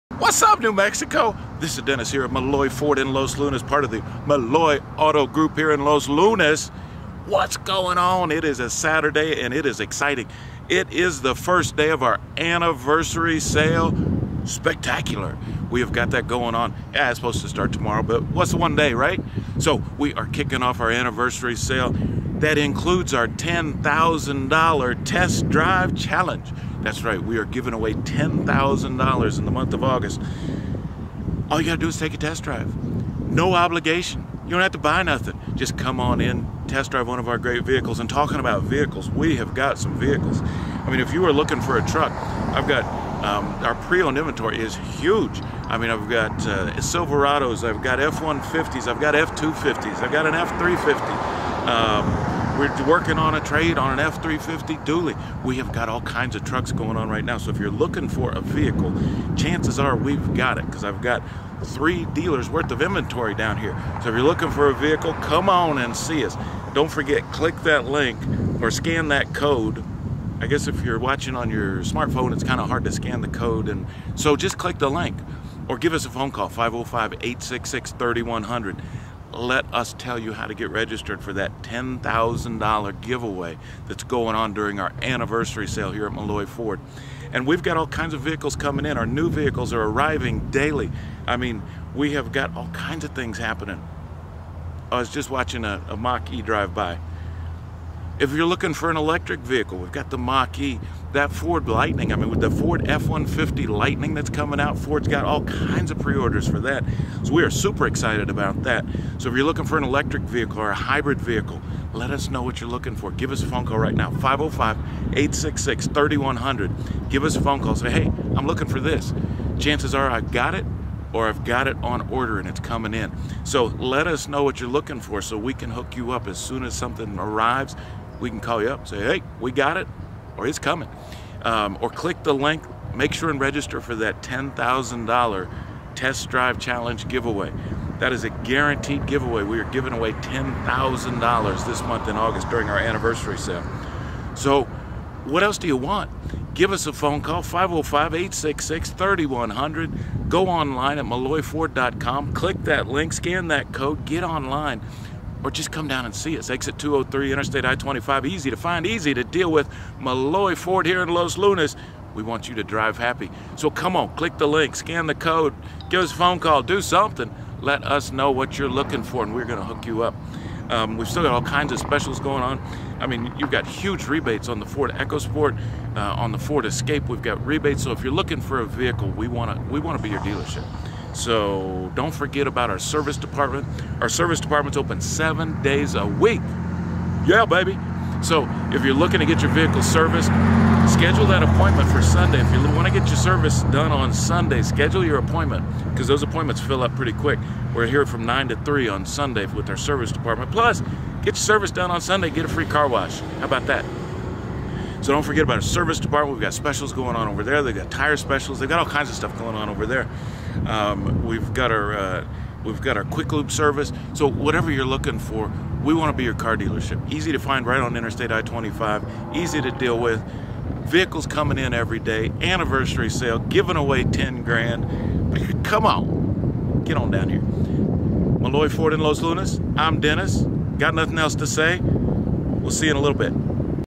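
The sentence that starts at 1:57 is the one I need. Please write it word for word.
Say, hey, I'm looking for this.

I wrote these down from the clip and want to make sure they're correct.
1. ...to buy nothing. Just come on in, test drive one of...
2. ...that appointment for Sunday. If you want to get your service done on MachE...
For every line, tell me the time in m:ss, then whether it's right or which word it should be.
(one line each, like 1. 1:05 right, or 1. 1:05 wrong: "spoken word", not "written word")
1. 0:34 right
2. 3:11 wrong: "Sunday", not "MachE".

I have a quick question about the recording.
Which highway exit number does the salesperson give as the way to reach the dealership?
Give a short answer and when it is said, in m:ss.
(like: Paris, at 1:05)
203, at 2:36.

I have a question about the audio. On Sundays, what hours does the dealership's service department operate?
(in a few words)
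9 to 3.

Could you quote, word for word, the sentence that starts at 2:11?
Um, or click the link, make sure and register for that $10,000 test drive challenge giveaway.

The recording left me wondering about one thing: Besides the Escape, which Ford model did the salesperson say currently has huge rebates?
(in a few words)
Ford EcoSport.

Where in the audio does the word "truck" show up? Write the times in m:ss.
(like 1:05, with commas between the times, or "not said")
0:41, 0:56.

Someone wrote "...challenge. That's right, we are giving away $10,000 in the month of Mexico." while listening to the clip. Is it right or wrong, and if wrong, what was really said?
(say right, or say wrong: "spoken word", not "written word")
wrong: "August", not "Mexico".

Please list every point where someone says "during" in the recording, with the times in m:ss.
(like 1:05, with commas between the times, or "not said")
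1:24, 2:22.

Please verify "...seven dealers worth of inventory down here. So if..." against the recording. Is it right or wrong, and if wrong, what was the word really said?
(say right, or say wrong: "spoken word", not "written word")
wrong: "three", not "seven".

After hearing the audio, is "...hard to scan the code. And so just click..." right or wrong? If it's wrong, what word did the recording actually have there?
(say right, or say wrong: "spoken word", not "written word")
right.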